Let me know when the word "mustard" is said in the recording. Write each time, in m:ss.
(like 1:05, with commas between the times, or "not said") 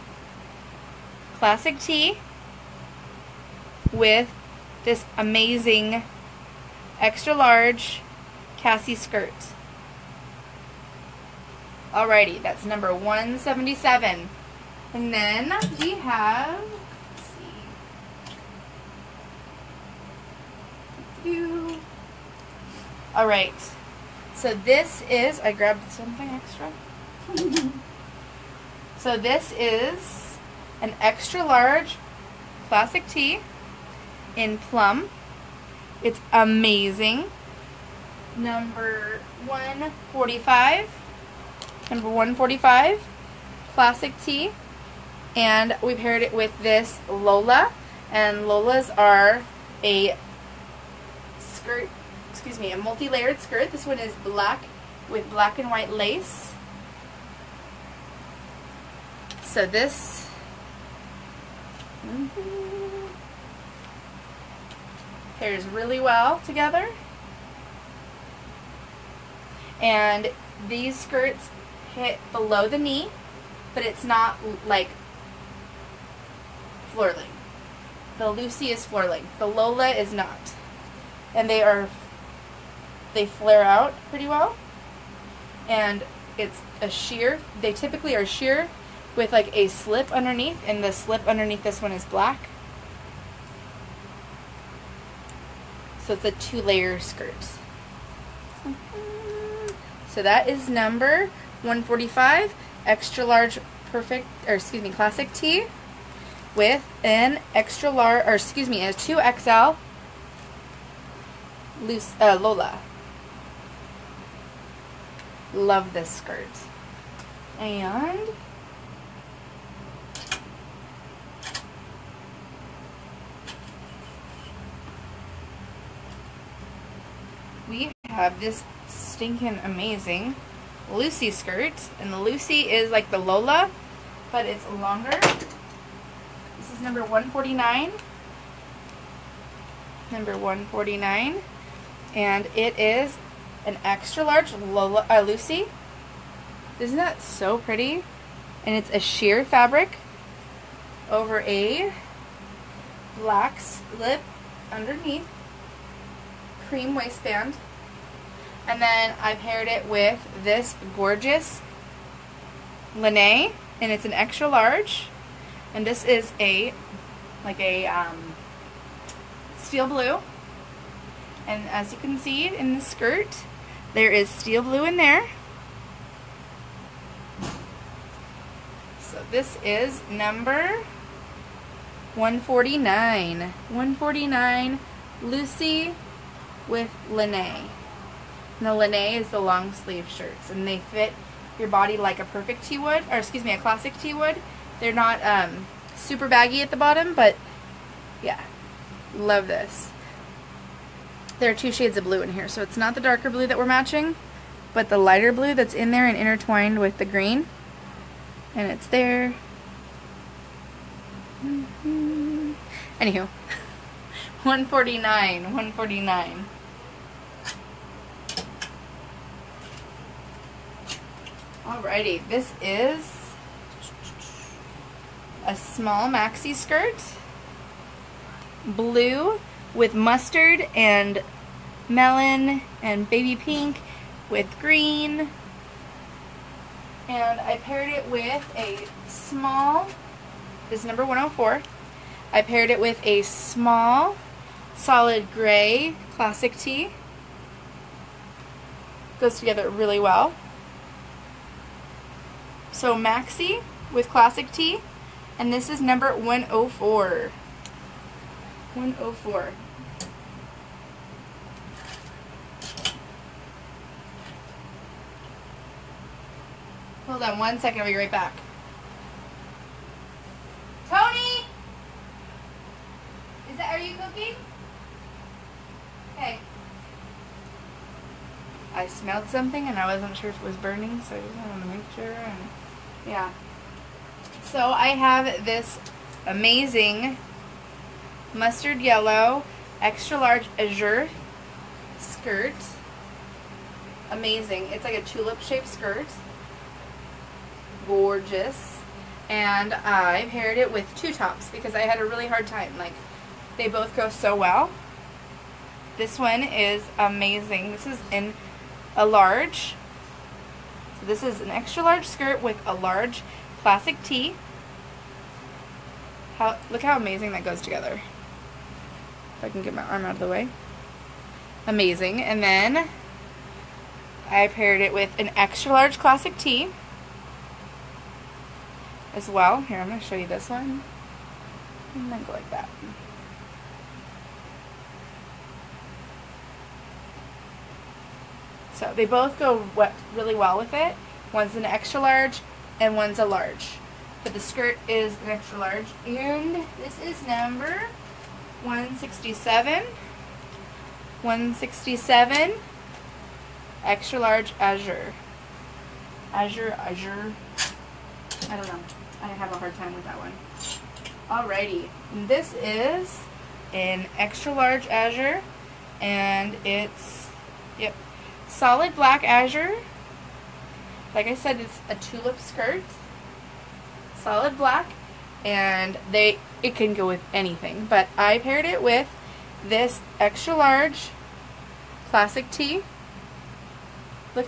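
3:49, 4:48.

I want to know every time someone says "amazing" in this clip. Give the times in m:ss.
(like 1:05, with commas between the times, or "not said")
0:05, 0:36, 2:09, 4:46, 4:54, 5:06, 5:16, 5:21.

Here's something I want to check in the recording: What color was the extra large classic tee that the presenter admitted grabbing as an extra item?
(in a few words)
Plum.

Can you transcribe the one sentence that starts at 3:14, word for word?
They're not um, super baggy at the bottom, but yeah, love this.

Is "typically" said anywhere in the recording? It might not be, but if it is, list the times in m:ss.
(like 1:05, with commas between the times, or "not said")
1:27.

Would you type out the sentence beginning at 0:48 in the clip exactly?
And Lolas are a skirt, excuse me, a multi-layered skirt.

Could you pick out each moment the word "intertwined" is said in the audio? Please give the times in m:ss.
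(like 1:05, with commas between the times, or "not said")
3:26.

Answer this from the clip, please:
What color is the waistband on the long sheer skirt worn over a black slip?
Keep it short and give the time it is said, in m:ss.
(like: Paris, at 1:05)
Cream, at 2:36.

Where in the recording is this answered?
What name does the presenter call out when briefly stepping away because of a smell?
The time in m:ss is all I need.
4:30.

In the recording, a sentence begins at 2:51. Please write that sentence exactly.
And as you can see in the skirt, there is steel blue in there.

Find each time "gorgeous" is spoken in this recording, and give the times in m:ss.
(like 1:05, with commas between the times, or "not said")
2:40, 4:57.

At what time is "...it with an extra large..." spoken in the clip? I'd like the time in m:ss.
5:24.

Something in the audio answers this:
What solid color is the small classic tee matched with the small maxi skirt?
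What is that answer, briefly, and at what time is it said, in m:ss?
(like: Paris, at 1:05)
Gray, at 4:04.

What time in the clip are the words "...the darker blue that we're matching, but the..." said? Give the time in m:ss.
3:22.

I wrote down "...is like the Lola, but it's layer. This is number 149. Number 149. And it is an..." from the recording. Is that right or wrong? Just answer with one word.
wrong.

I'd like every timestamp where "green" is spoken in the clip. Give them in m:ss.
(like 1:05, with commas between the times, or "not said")
3:27, 3:54.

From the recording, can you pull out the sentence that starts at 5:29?
Here, I'm going to show you this one.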